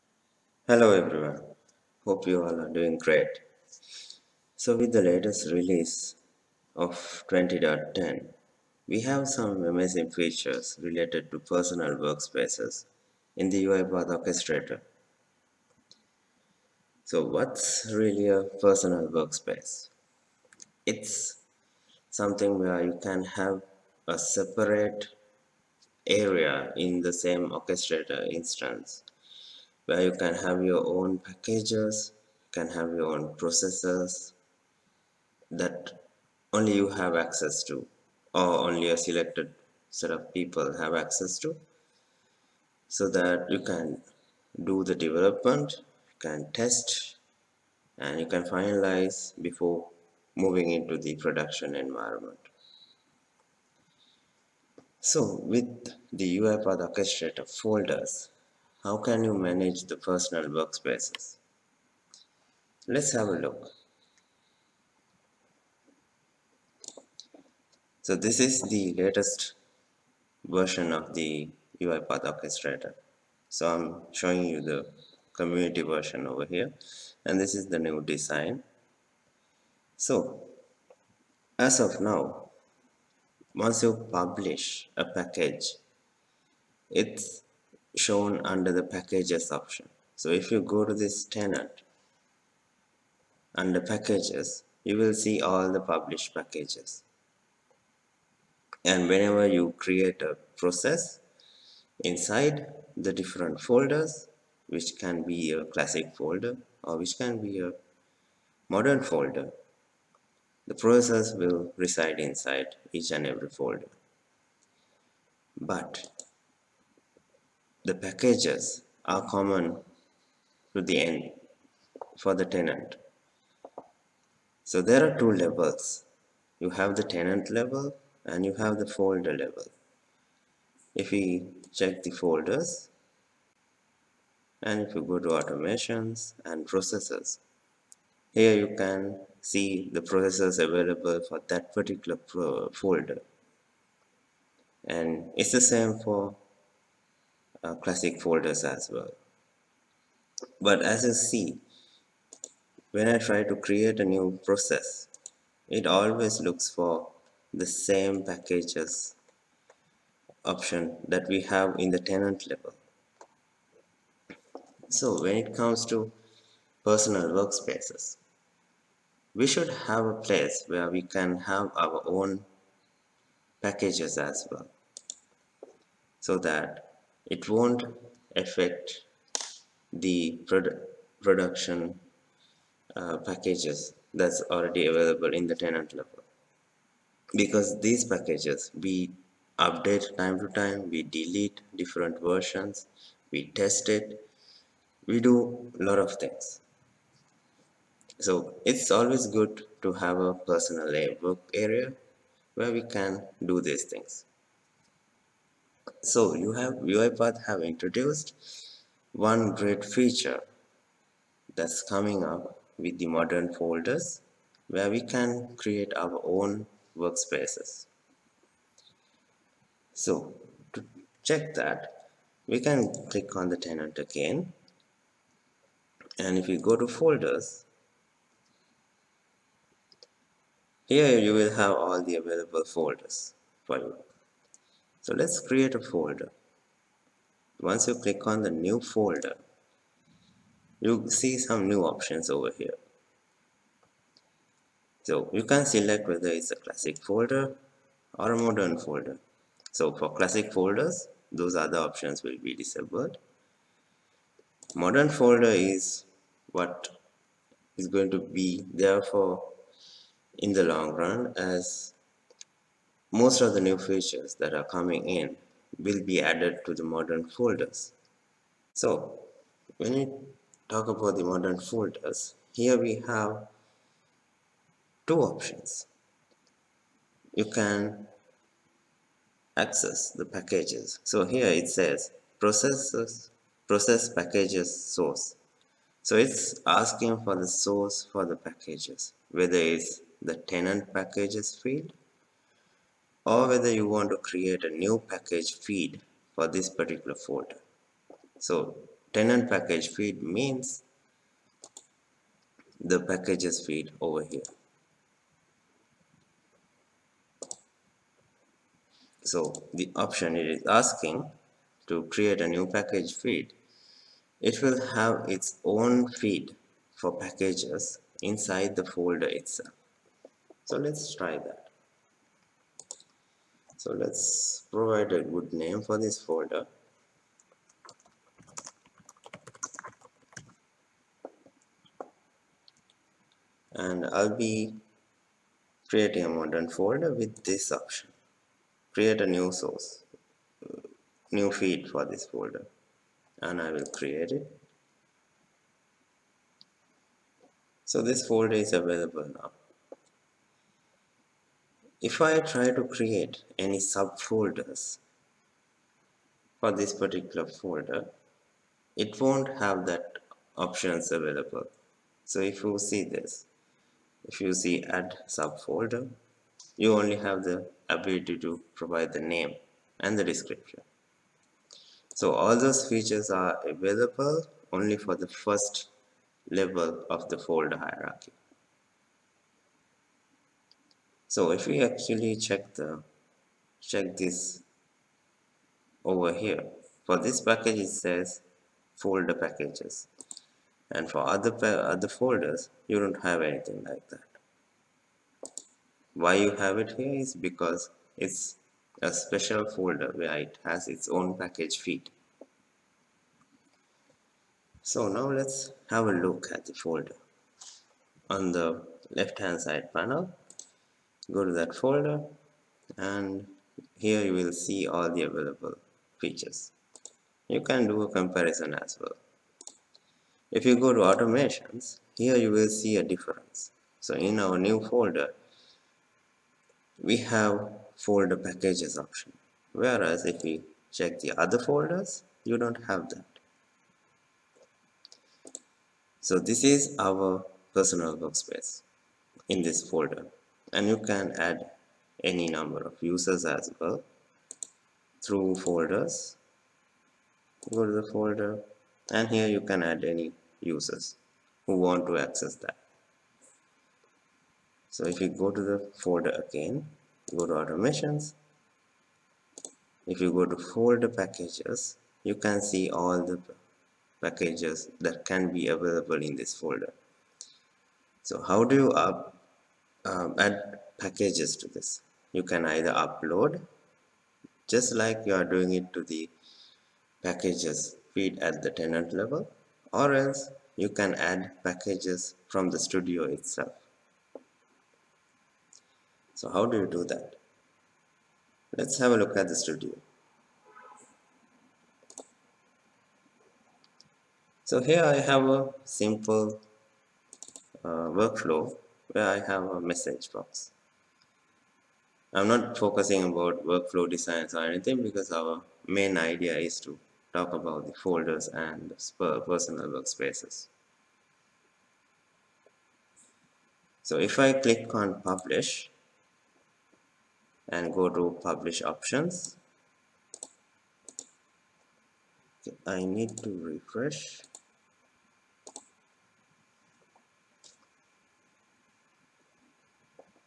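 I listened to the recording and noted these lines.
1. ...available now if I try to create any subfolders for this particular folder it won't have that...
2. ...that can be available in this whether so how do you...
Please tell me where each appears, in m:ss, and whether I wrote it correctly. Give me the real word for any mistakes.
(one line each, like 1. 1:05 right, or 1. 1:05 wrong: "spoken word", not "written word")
1. 5:48 right
2. 7:45 wrong: "folder", not "whether".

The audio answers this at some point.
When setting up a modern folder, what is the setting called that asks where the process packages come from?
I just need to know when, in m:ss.
4:43.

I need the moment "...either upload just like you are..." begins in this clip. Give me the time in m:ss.
7:52.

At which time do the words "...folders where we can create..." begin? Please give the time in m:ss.
3:33.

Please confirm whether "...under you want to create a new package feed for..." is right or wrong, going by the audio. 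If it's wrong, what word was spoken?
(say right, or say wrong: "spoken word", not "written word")
wrong: "whether", not "under".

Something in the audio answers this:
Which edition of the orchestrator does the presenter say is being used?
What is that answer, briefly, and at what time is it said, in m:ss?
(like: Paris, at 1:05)
community version, at 1:15.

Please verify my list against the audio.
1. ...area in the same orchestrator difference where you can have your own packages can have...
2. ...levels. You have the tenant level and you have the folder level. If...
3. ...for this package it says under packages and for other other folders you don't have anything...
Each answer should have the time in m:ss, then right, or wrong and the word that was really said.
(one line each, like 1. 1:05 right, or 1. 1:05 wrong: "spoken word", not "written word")
1. 0:26 wrong: "instance", not "difference"
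2. 2:05 right
3. 6:27 wrong: "folder", not "under".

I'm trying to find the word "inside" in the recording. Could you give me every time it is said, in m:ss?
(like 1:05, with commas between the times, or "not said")
1:42, 1:52, 5:18.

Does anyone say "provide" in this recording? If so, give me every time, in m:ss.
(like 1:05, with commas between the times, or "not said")
5:24, 6:08.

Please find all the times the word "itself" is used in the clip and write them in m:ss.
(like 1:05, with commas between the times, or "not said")
5:19, 8:03.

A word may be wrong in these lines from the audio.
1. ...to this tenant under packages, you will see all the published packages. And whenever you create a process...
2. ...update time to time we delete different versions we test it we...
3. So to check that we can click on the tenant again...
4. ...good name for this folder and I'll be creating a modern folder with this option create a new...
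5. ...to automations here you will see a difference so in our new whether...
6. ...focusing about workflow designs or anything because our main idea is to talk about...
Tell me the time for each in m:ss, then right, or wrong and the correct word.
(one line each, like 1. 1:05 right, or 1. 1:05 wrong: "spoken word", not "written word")
1. 1:30 right
2. 3:09 right
3. 3:39 right
4. 5:25 right
5. 7:00 wrong: "folder", not "whether"
6. 8:22 right.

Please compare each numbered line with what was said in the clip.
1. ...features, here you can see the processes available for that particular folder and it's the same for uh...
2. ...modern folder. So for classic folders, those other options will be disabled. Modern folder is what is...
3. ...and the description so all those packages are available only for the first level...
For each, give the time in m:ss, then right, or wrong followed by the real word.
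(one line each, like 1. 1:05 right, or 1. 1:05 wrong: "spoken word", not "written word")
1. 2:16 wrong: "processes", not "features"
2. 4:08 right
3. 6:09 wrong: "features", not "packages".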